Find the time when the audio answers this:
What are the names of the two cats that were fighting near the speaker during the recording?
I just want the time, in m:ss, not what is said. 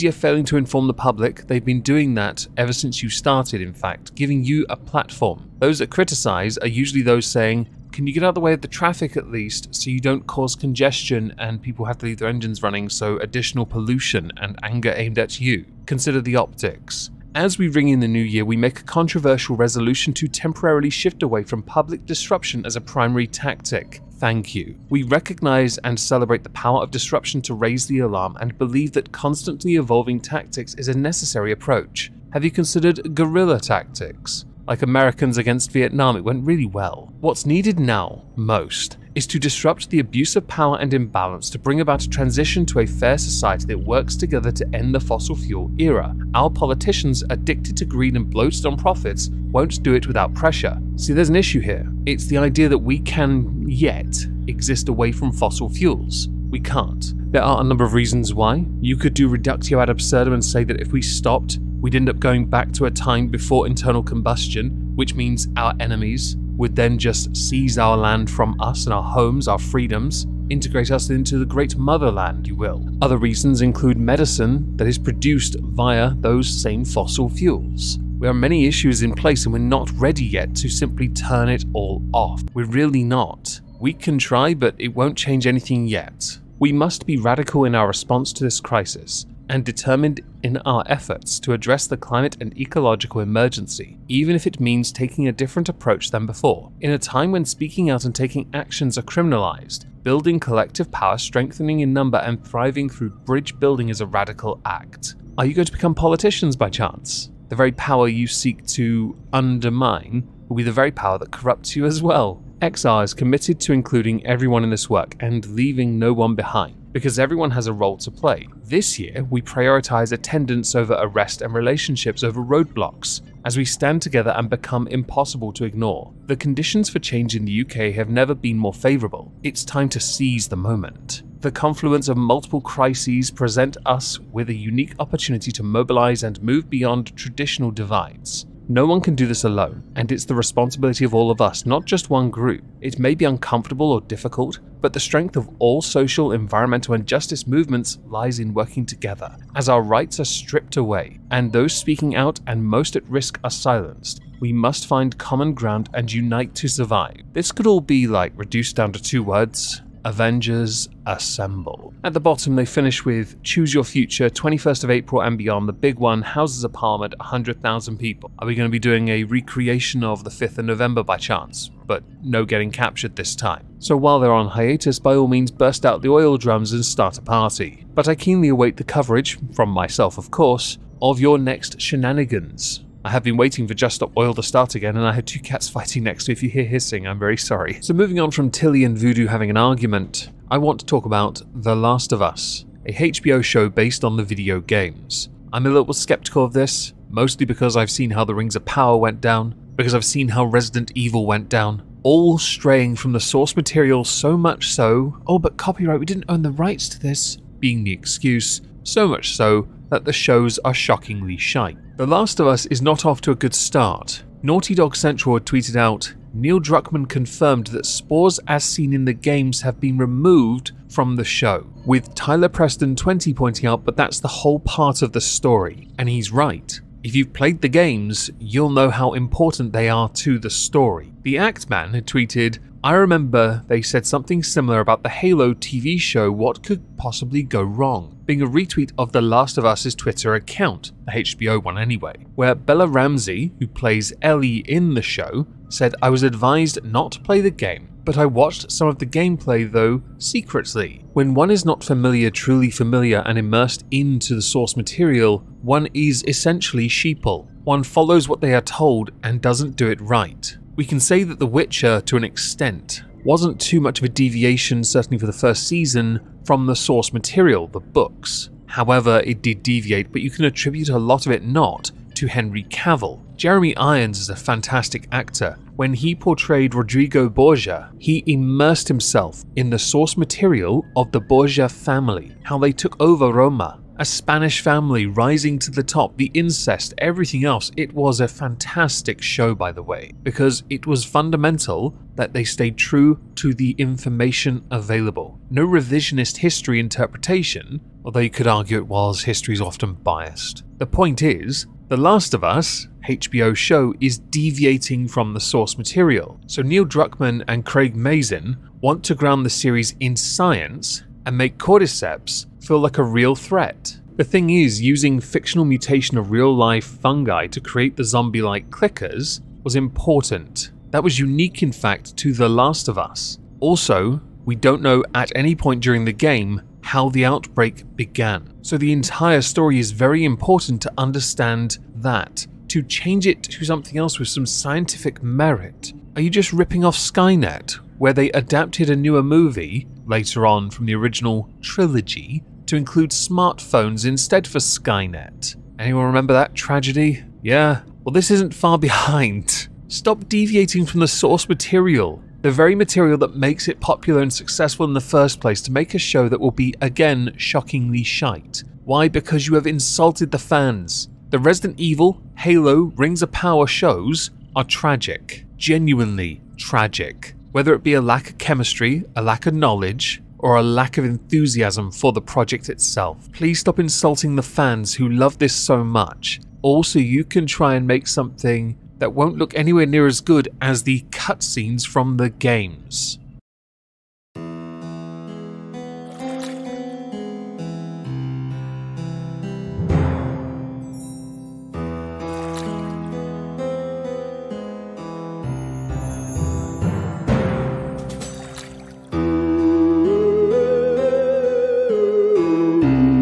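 3:08.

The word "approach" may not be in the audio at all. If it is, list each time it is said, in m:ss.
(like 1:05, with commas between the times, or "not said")
0:31, 1:35.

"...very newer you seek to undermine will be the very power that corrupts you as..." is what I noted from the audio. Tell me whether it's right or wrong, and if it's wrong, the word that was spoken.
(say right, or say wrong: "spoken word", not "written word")
wrong: "power", not "newer".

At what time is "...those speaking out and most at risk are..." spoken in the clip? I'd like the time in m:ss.
2:31.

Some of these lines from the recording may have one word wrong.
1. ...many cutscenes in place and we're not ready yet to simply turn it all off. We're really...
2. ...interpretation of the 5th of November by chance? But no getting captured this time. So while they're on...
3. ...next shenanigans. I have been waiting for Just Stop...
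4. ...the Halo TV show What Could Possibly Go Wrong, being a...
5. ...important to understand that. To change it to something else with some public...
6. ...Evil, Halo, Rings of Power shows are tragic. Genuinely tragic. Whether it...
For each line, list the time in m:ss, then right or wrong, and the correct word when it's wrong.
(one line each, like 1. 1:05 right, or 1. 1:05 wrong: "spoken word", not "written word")
1. 1:18 wrong: "issues", not "cutscenes"
2. 2:49 wrong: "recreation", not "interpretation"
3. 3:01 right
4. 3:55 right
5. 5:30 wrong: "scientific", not "public"
6. 6:01 right.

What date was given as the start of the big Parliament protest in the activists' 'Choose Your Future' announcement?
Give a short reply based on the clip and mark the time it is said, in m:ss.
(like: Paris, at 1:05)
21st of April, at 2:44.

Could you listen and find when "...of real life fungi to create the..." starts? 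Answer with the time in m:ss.
5:16.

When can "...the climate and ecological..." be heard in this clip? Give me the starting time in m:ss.
1:31.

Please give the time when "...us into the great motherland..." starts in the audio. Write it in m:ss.
1:10.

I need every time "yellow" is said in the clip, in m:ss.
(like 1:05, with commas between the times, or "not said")
not said.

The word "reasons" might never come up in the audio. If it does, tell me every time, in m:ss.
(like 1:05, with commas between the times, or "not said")
0:57, 1:13.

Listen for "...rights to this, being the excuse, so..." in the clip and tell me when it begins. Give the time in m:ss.
3:26.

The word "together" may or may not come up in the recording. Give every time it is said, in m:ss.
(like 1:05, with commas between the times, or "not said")
0:44, 2:03, 2:28.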